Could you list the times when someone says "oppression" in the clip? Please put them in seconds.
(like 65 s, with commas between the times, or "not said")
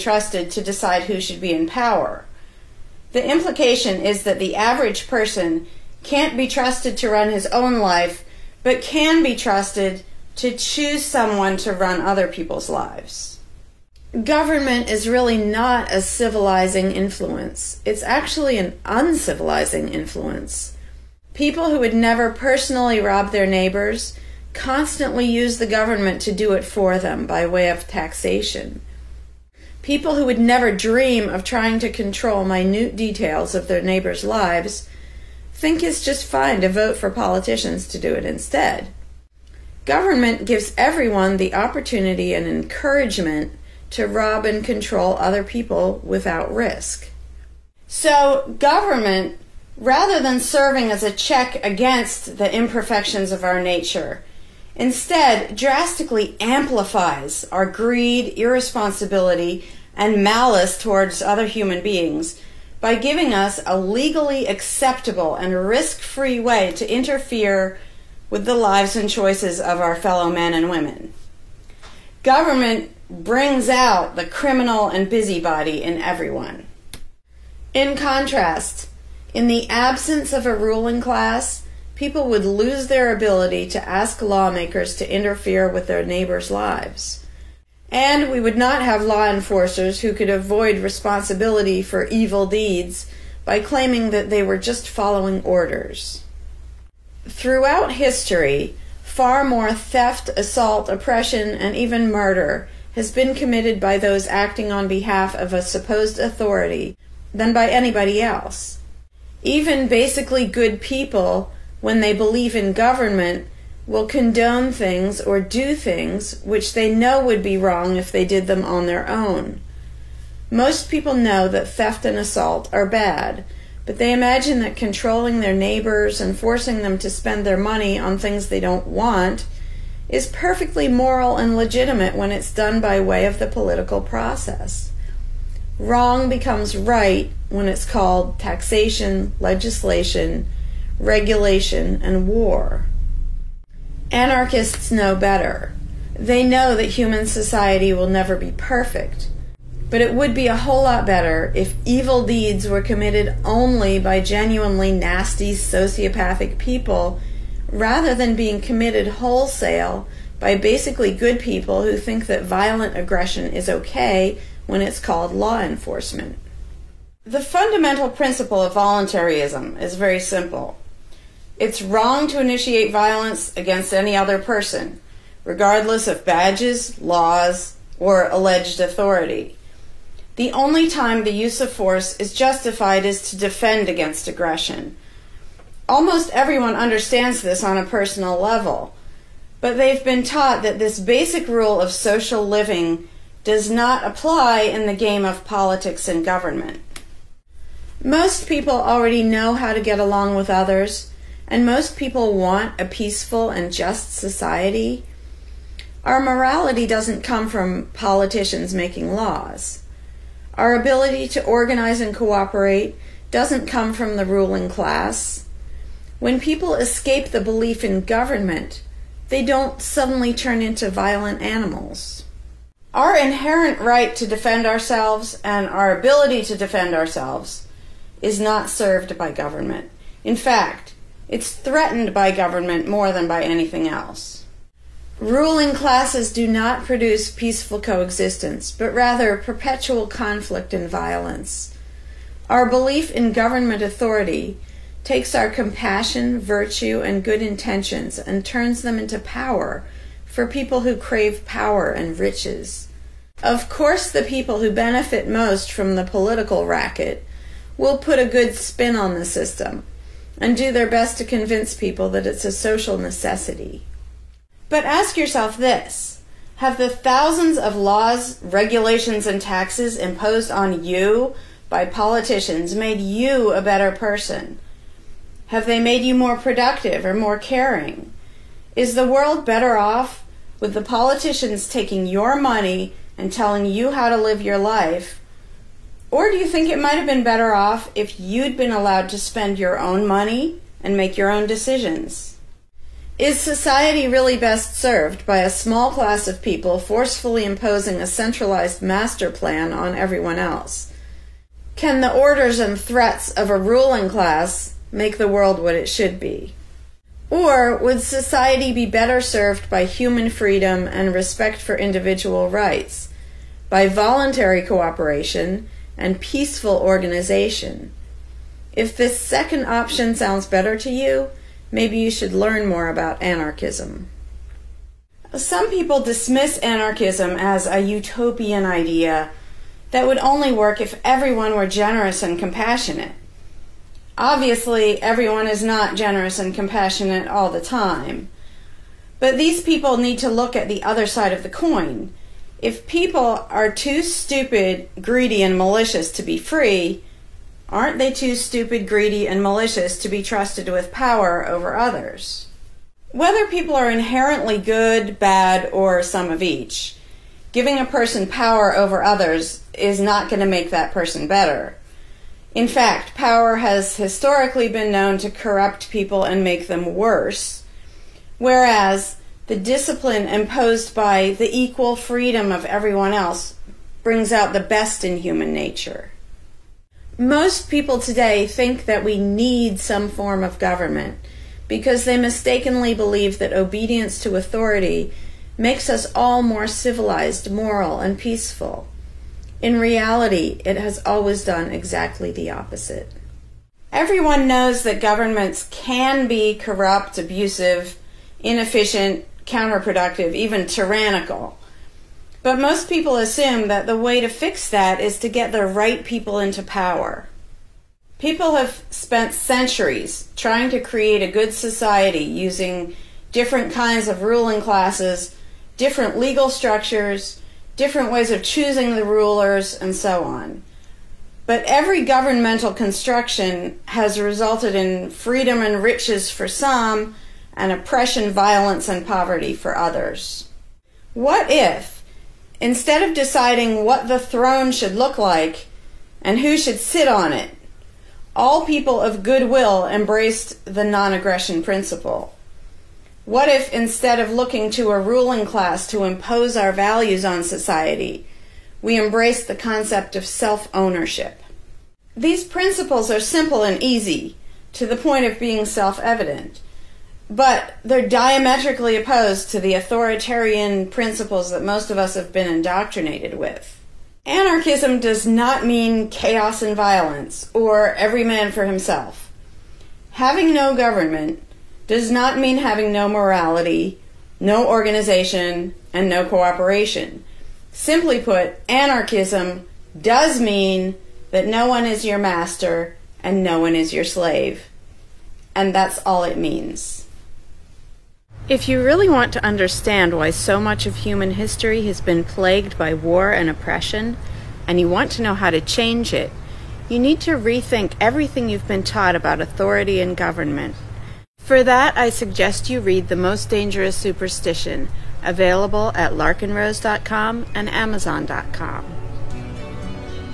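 100 s, 427 s, 493 s.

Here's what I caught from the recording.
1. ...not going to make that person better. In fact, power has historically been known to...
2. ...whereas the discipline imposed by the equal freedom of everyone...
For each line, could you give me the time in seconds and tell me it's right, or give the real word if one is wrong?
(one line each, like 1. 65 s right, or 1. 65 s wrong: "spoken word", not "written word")
1. 359 s right
2. 368 s right.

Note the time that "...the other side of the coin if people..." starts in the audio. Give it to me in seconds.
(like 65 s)
340 s.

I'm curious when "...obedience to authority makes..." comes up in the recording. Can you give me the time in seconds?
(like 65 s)
383 s.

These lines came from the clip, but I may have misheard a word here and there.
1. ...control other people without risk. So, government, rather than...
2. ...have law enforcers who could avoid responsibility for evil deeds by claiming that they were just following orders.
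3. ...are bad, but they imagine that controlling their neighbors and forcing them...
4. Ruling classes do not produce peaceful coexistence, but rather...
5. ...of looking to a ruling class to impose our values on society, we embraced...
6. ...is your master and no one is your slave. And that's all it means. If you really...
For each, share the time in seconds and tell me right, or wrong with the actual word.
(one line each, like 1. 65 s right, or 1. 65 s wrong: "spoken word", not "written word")
1. 44 s right
2. 88 s right
3. 122 s right
4. 235 s right
5. 444 s right
6. 481 s right.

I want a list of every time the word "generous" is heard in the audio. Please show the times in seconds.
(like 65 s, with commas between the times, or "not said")
331 s, 335 s.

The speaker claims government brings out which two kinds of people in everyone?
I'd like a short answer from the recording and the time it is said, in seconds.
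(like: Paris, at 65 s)
criminal and busybody, at 74 s.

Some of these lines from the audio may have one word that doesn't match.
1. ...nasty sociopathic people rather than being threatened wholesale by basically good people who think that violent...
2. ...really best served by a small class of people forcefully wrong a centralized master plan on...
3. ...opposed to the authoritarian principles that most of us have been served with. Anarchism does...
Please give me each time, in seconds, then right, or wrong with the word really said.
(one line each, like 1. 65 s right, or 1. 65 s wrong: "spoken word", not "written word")
1. 154 s wrong: "committed", not "threatened"
2. 294 s wrong: "imposing", not "wrong"
3. 458 s wrong: "indoctrinated", not "served".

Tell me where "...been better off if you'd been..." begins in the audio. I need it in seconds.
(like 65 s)
287 s.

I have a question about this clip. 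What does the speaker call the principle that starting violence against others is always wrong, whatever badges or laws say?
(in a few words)
voluntarism.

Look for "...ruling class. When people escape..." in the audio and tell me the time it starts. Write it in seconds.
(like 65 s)
214 s.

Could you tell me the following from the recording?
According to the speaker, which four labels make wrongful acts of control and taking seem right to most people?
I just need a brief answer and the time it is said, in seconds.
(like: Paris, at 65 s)
taxation, legislation, regulation, and war, at 138 s.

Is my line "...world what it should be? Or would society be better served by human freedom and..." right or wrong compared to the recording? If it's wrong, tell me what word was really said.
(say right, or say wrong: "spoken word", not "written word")
right.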